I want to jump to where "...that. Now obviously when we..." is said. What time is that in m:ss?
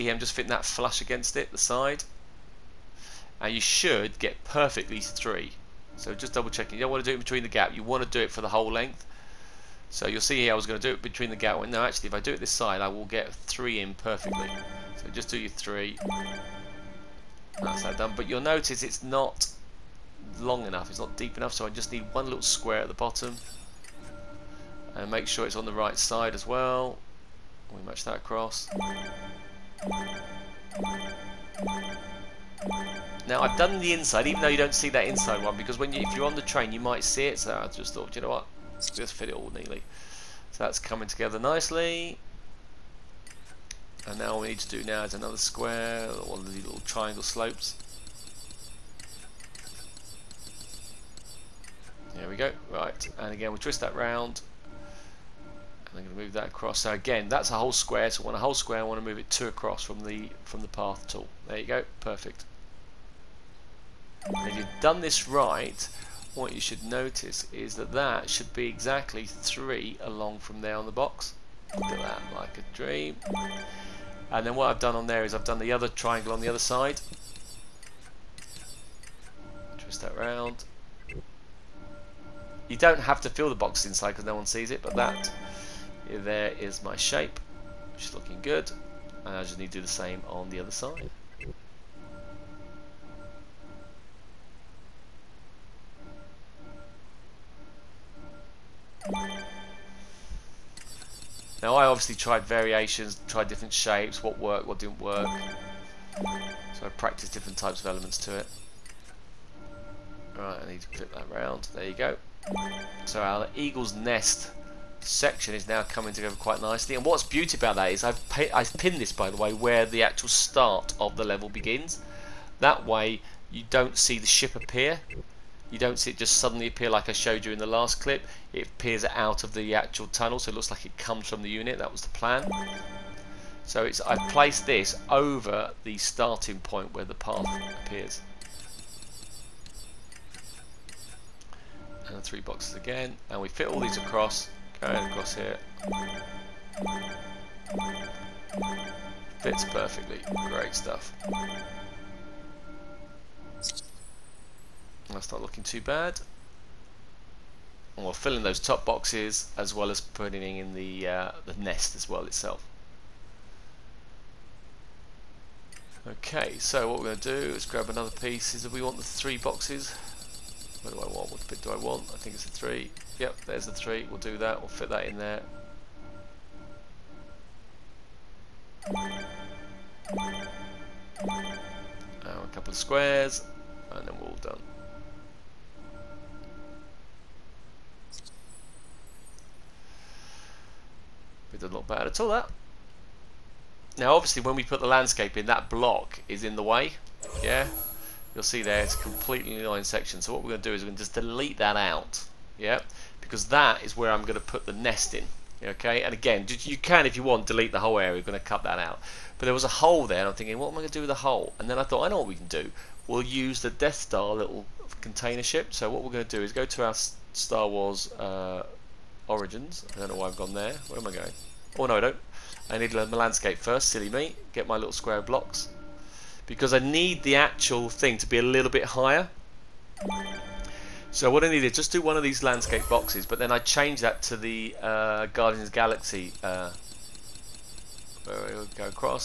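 3:12.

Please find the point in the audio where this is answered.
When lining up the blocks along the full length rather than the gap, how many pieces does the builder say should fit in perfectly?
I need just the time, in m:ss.
0:04.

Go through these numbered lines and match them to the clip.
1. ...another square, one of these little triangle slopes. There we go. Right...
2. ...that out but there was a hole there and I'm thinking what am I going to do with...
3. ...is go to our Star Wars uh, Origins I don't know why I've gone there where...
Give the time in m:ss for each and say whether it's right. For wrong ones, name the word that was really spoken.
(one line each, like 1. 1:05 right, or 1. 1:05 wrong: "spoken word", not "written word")
1. 0:45 right
2. 3:28 right
3. 3:36 right.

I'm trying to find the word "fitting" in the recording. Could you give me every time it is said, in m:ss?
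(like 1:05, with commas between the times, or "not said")
0:00.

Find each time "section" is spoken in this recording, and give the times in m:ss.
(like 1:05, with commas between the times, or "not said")
1:55, 3:19.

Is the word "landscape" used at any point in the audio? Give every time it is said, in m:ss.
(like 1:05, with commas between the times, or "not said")
3:14, 3:43, 3:52.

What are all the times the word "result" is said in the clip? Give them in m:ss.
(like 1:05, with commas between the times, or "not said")
not said.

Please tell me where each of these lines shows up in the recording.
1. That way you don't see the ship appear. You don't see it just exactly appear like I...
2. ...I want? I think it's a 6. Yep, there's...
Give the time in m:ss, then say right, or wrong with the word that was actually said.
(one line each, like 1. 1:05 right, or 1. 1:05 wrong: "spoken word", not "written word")
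1. 2:02 wrong: "suddenly", not "exactly"
2. 2:51 wrong: "3", not "6".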